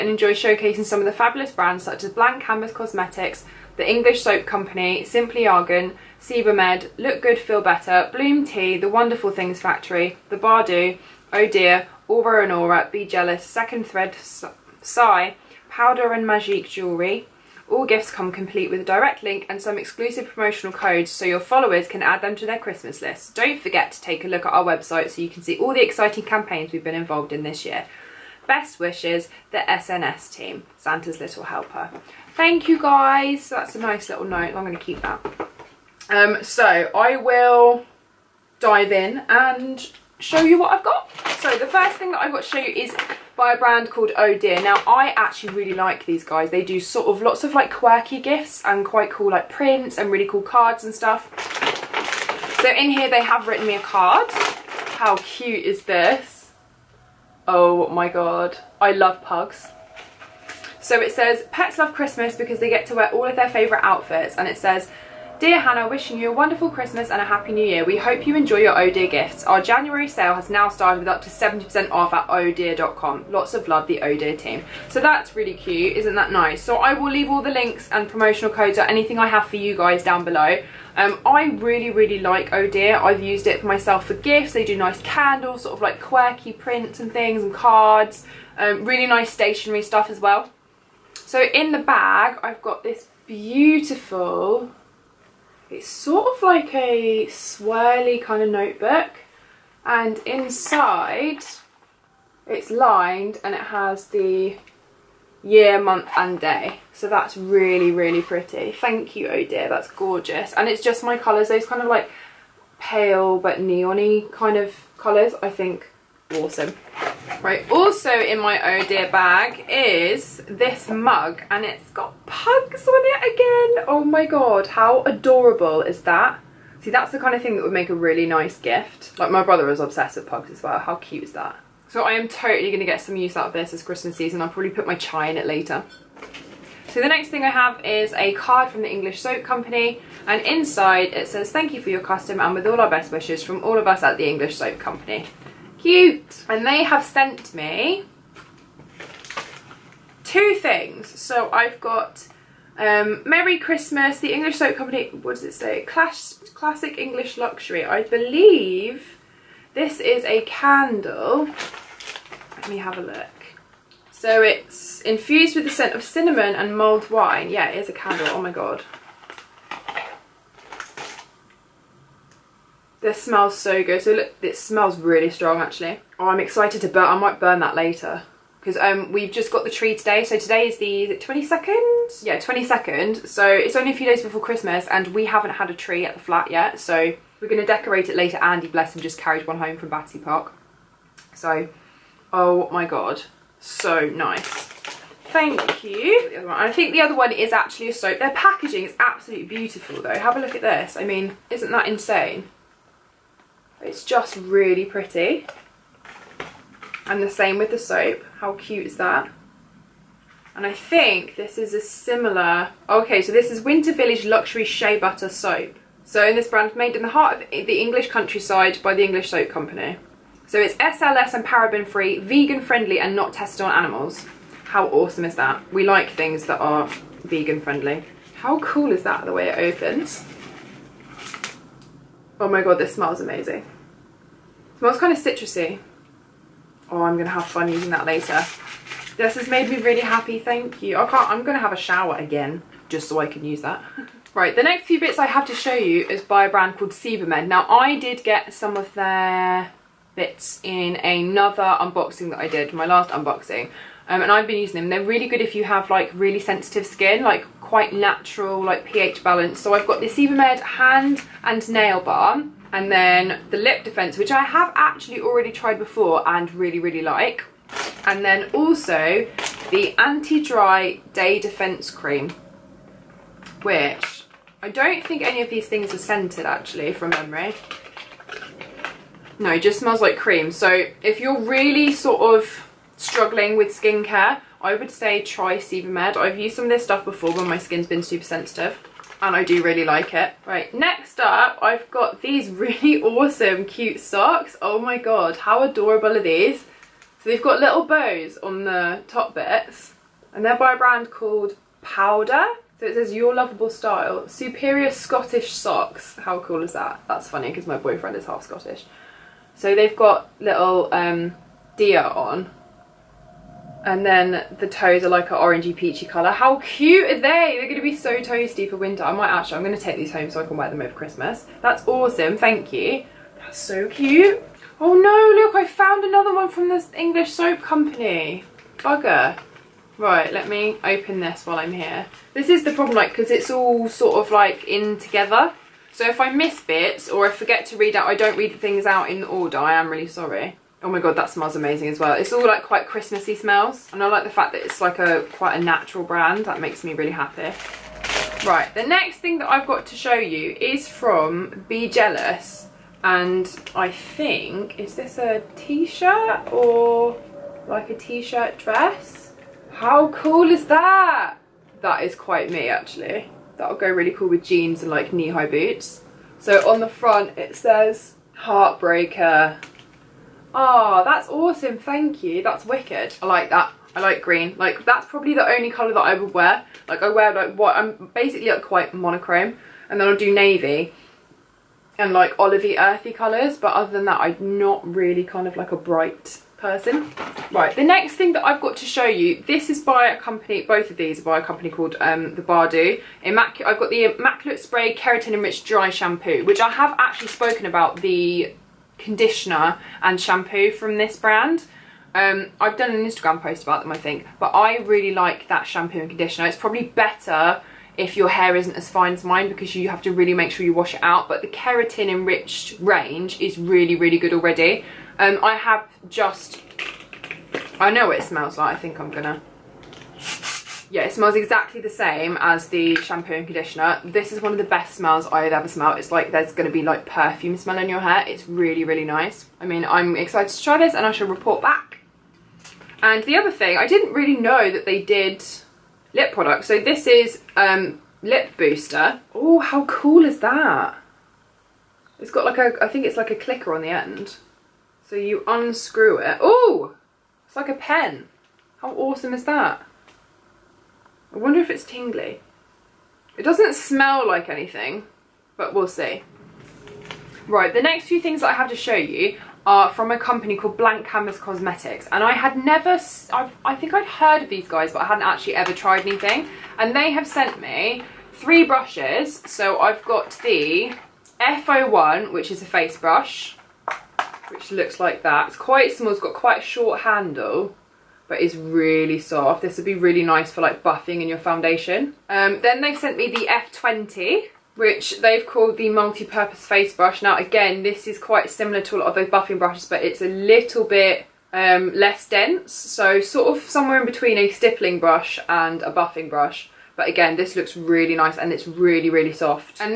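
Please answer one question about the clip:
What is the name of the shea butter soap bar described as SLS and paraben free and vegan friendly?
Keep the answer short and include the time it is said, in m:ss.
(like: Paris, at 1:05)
Winter Village, at 3:33.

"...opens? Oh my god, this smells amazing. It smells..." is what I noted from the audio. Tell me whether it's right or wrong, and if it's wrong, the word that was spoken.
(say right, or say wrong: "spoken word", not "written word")
right.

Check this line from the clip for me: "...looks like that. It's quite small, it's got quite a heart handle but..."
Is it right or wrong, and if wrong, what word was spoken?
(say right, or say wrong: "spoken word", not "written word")
wrong: "short", not "heart".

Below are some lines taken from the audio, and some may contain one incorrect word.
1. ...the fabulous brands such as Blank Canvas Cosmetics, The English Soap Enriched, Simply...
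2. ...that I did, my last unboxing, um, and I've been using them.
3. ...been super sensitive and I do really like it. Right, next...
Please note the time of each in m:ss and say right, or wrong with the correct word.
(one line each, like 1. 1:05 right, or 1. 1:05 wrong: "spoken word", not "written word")
1. 0:01 wrong: "Company", not "Enriched"
2. 4:12 right
3. 4:47 right.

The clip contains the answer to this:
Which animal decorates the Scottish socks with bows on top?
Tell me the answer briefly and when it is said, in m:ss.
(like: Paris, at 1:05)
deer, at 5:11.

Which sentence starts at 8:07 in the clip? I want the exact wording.
Now again, this is quite similar to a lot of those buffing brushes, but it's a little bit um, less dense.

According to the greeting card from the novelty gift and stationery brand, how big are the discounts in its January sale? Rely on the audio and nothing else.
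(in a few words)
up to 70% off.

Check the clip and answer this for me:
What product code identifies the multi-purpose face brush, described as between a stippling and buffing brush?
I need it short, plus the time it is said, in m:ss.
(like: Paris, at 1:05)
F20, at 8:03.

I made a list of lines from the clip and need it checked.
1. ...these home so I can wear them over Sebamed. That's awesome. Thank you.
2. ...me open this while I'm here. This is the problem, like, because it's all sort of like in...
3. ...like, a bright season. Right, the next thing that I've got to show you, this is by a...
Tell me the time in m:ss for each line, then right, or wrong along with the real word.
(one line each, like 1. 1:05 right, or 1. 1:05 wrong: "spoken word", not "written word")
1. 5:19 wrong: "Christmas", not "Sebamed"
2. 5:30 right
3. 6:25 wrong: "person", not "season".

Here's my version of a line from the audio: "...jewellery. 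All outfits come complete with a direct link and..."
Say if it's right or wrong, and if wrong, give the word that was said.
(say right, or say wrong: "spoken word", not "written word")
wrong: "gifts", not "outfits".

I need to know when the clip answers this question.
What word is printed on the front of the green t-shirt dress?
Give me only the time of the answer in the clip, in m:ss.
6:08.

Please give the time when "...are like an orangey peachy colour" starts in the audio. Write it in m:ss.
5:15.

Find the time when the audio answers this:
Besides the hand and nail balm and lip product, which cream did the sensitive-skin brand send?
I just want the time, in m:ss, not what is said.
4:29.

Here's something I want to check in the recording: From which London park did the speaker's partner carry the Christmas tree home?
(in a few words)
Battersea Park.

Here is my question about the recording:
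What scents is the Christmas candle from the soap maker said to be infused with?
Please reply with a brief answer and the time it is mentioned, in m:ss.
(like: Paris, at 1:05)
cinnamon and mulled wine, at 2:46.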